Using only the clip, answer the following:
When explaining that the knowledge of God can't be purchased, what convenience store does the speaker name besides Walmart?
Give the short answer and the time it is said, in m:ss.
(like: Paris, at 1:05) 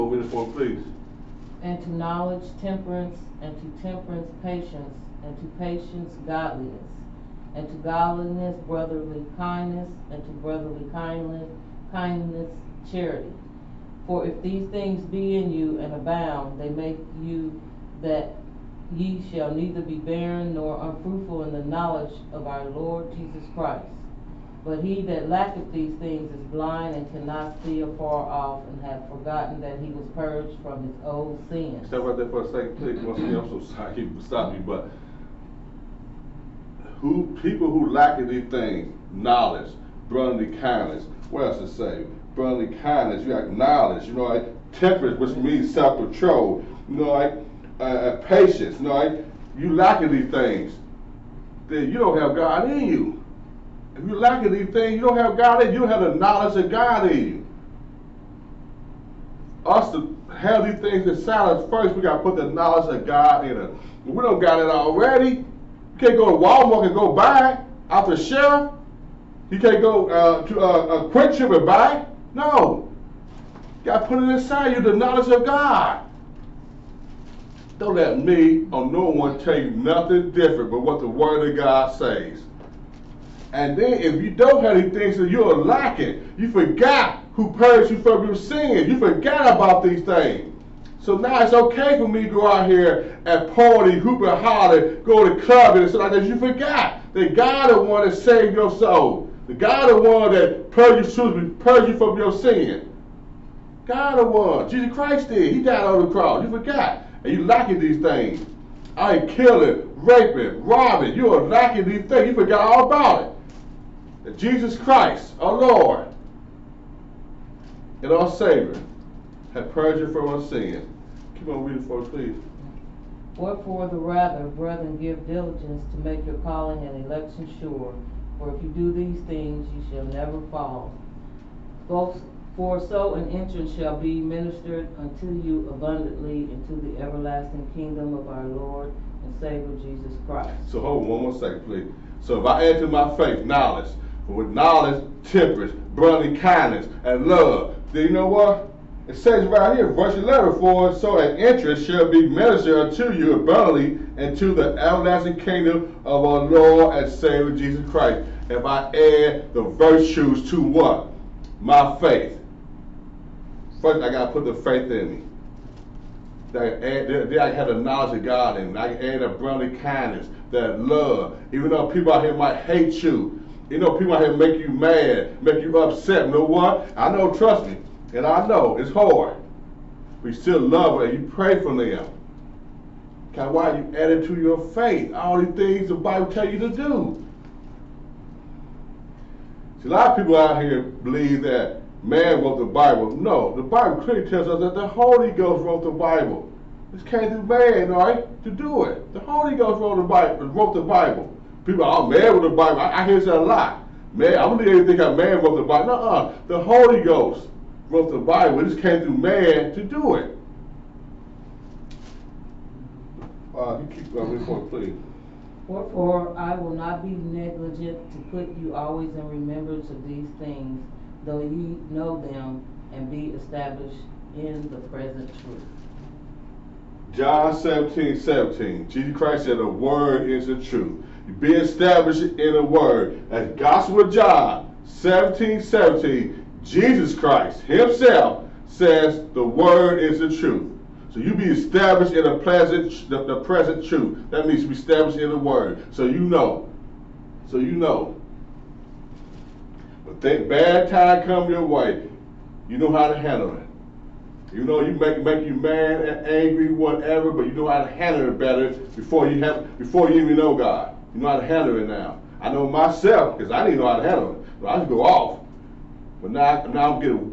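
QuikTrip, at 1:11.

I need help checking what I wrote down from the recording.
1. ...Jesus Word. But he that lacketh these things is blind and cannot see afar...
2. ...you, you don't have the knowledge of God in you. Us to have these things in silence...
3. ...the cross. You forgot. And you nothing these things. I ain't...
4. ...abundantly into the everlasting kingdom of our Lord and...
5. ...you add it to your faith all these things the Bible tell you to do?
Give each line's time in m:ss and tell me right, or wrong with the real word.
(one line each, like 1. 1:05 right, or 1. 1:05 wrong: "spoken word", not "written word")
1. 0:23 wrong: "Christ", not "Word"
2. 0:55 right
3. 1:46 wrong: "lacking", not "nothing"
4. 2:15 right
5. 3:03 right.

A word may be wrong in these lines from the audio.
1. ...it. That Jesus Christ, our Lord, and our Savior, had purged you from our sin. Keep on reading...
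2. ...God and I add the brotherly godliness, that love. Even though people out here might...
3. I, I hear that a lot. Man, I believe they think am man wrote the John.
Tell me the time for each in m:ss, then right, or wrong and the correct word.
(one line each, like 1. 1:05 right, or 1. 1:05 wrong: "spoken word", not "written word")
1. 1:53 right
2. 2:48 wrong: "kindness", not "godliness"
3. 3:22 wrong: "Bible", not "John".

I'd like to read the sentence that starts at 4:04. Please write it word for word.
That means be established in the word.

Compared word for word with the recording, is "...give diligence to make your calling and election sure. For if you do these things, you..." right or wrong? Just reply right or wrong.
right.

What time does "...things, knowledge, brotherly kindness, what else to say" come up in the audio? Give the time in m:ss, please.
0:38.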